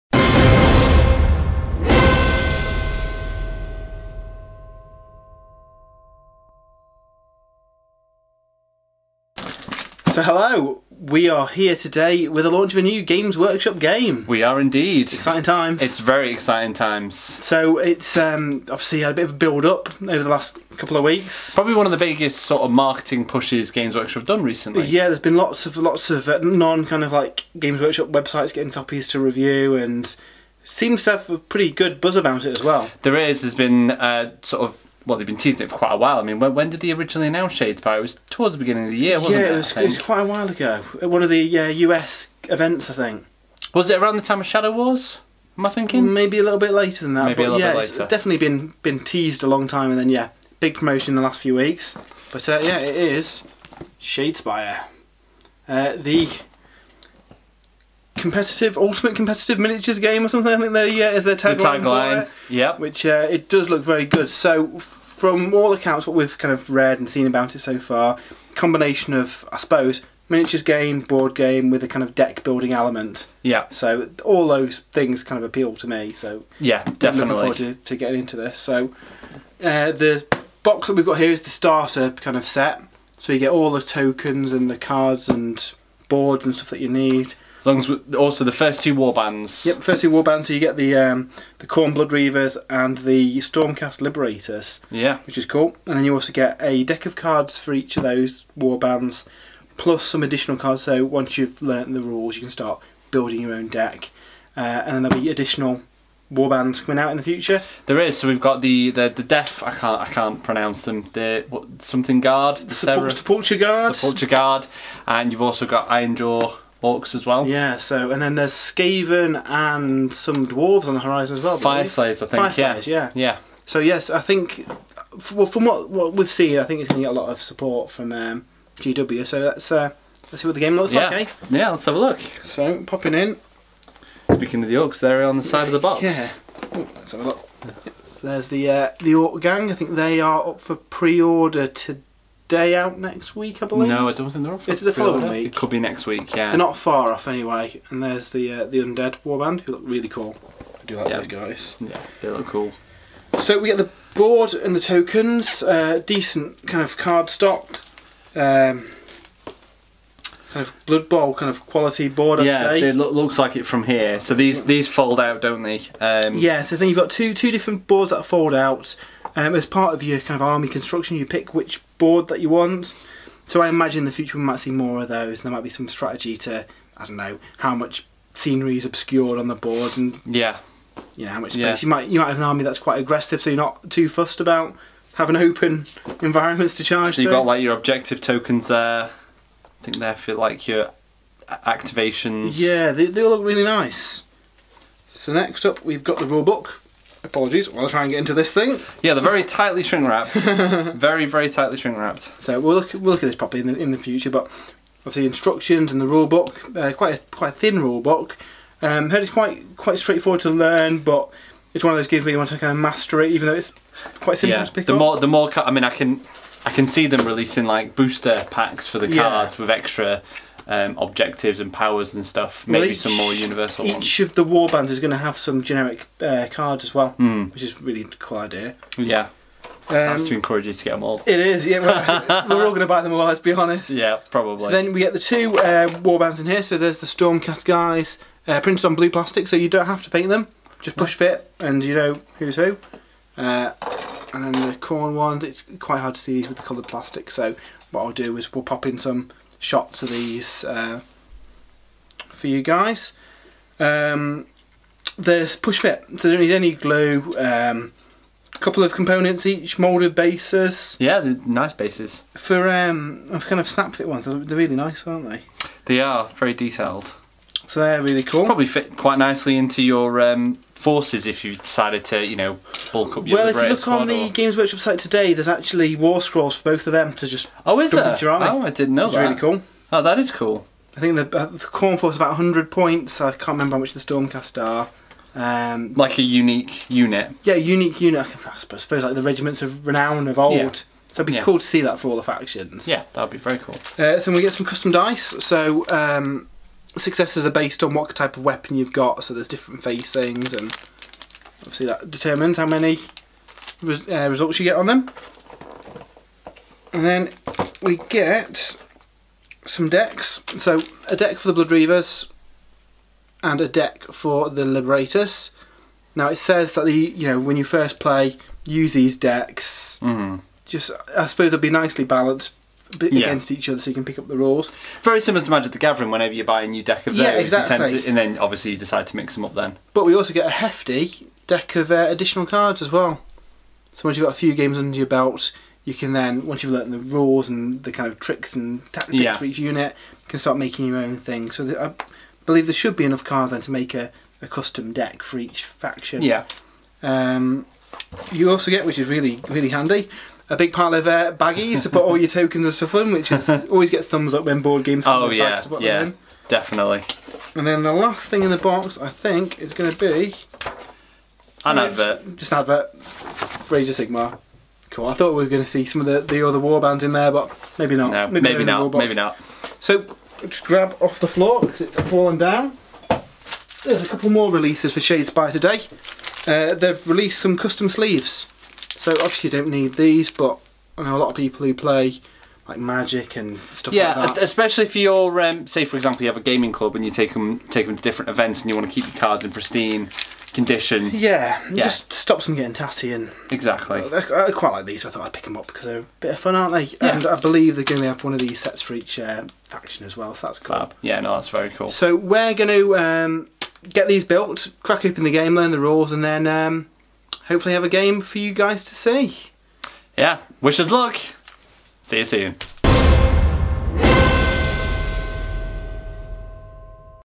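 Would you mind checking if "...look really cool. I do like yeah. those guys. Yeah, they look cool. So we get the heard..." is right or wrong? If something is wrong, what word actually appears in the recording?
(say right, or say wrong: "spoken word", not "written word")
wrong: "board", not "heard".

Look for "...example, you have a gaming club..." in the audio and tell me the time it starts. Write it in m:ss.
6:25.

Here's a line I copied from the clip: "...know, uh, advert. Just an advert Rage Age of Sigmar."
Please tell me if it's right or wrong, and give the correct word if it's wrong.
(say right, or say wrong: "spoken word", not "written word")
right.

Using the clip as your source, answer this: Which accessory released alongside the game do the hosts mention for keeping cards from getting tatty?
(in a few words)
custom sleeves.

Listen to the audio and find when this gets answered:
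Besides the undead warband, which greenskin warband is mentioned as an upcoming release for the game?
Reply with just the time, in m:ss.
1:55.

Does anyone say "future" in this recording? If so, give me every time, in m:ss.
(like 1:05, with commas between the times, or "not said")
1:47, 2:54, 3:23.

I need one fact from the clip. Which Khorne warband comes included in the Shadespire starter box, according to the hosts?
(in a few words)
Khorne Blood Reavers.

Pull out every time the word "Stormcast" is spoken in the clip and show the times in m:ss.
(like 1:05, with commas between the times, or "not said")
1:33, 3:57, 4:43.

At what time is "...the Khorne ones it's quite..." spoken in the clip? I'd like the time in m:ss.
4:04.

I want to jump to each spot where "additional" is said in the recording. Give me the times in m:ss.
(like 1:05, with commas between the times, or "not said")
1:40, 1:45, 5:32.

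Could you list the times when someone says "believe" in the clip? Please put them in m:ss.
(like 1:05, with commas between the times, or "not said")
2:23, 5:42, 6:37.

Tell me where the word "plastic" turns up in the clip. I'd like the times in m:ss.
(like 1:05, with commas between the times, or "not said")
3:59, 4:06.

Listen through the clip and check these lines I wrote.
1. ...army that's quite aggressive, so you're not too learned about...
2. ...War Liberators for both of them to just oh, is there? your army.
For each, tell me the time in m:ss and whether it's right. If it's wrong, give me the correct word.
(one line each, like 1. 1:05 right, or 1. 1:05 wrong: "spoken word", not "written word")
1. 3:02 wrong: "fussed", not "learned"
2. 4:35 wrong: "Scrolls", not "Liberators".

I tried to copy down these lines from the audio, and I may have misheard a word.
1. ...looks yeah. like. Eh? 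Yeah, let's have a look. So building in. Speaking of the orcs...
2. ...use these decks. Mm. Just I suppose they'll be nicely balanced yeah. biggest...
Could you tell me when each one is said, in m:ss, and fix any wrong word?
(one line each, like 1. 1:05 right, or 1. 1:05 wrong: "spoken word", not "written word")
1. 2:10 wrong: "popping", not "building"
2. 5:18 wrong: "against", not "biggest".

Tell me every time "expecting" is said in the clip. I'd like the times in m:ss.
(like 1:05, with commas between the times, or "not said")
not said.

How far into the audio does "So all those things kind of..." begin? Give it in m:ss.
1:13.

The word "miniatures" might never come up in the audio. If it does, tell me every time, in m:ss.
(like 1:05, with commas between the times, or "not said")
0:59, 1:10.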